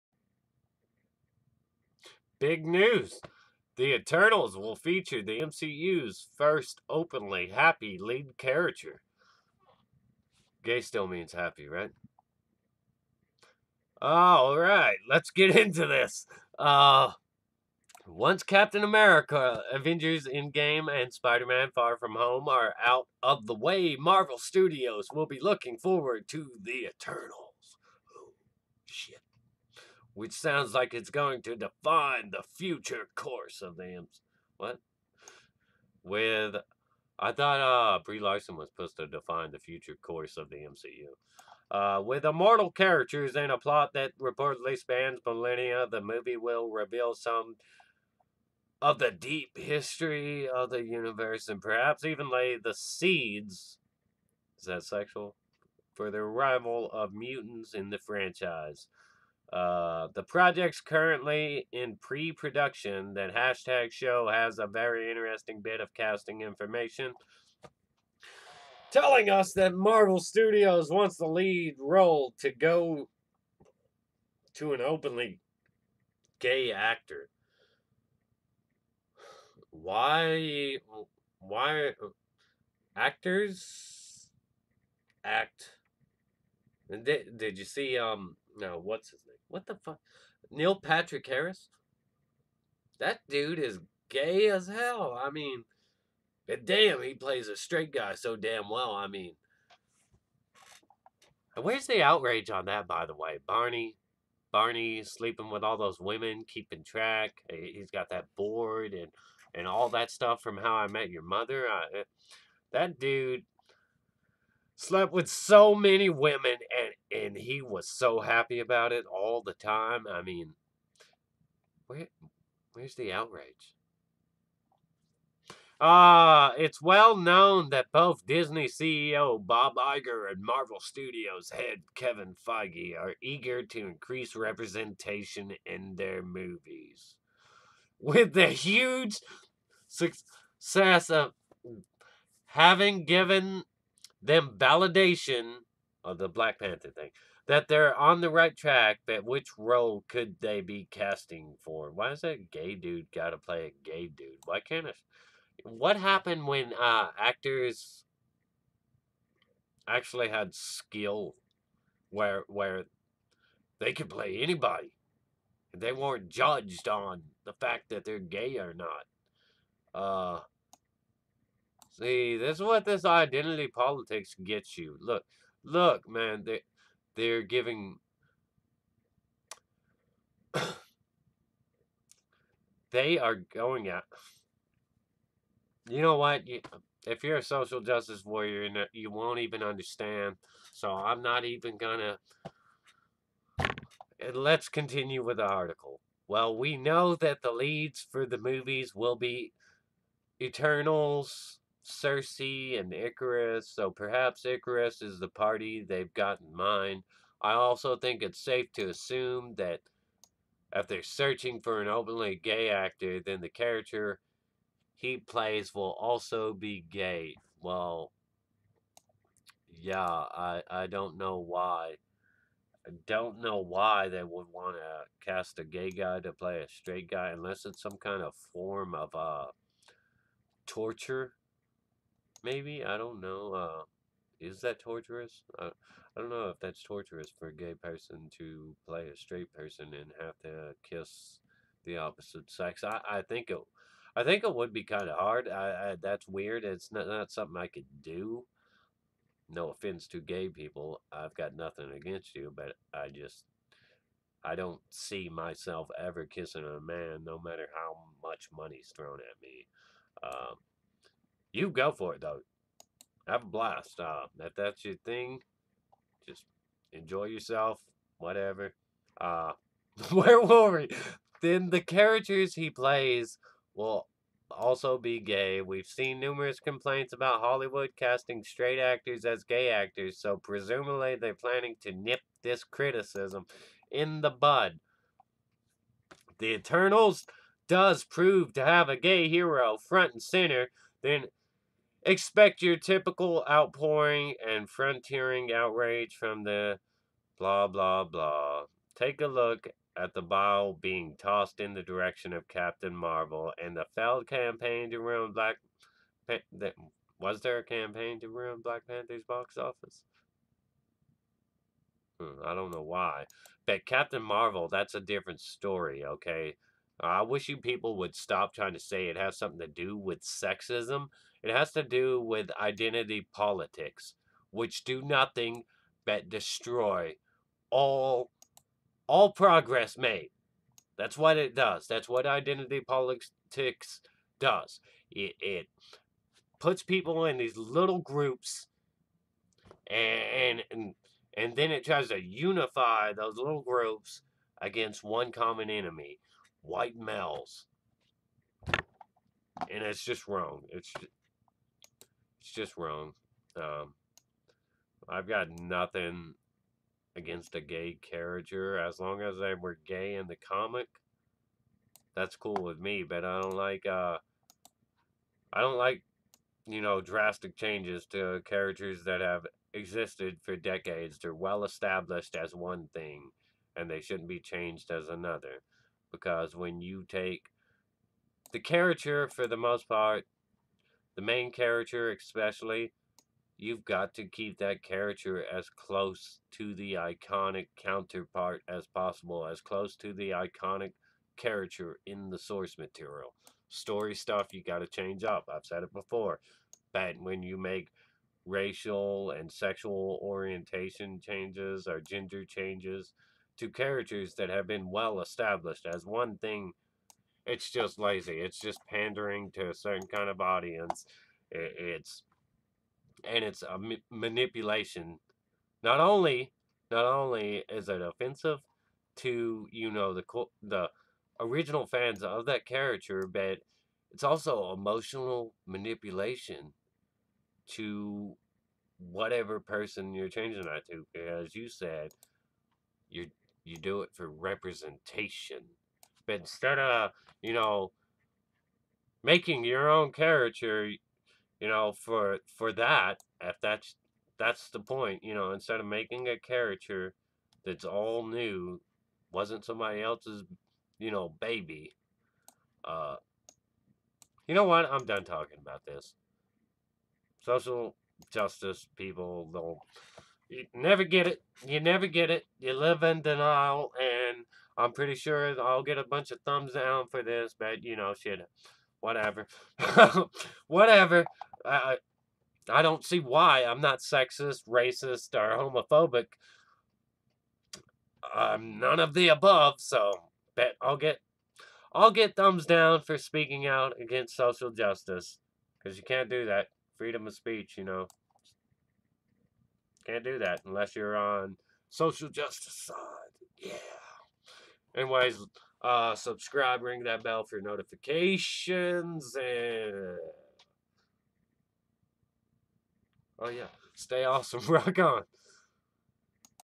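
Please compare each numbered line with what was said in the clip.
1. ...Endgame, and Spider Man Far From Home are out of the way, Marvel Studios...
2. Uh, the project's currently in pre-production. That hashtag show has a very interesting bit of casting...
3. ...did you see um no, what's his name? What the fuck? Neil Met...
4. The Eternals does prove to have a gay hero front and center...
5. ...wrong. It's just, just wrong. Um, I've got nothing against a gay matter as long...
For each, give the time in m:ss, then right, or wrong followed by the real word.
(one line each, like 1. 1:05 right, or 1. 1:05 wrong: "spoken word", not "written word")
1. 0:20 right
2. 0:59 right
3. 1:27 wrong: "Patrick", not "Met"
4. 4:46 right
5. 5:50 wrong: "character", not "matter".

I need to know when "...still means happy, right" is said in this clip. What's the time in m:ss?
0:10.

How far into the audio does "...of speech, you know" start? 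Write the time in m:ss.
8:07.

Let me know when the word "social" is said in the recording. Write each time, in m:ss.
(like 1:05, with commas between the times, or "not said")
3:07, 7:37, 8:04, 8:11.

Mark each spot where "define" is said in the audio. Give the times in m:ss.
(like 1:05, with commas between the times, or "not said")
0:31, 0:39.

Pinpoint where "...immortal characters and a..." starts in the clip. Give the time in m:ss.
0:42.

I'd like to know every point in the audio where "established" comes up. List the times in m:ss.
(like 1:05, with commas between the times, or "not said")
6:11, 6:45.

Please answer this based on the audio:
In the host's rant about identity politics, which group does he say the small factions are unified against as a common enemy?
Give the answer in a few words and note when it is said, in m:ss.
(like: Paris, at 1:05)
White males, at 5:46.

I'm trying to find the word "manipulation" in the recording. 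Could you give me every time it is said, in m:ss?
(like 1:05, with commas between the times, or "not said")
6:54, 7:05.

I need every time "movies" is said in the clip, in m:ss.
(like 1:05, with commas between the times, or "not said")
0:46, 2:16, 3:18.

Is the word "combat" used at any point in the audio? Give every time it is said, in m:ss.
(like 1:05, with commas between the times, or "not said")
not said.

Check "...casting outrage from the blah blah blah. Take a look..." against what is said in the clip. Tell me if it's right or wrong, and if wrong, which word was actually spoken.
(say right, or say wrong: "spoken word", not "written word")
wrong: "frontiering", not "casting".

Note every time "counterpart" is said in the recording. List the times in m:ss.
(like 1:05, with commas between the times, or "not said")
6:27.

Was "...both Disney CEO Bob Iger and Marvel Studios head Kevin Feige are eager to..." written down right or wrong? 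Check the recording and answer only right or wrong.
right.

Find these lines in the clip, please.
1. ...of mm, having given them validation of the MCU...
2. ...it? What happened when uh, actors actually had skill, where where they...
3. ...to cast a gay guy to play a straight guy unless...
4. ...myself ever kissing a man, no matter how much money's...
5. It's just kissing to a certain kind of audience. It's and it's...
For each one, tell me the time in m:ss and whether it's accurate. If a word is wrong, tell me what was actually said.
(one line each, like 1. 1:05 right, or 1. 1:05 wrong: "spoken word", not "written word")
1. 2:21 wrong: "Black", not "MCU"
2. 2:34 right
3. 3:44 right
4. 4:15 right
5. 6:48 wrong: "pandering", not "kissing".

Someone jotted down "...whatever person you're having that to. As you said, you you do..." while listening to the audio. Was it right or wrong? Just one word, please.
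wrong.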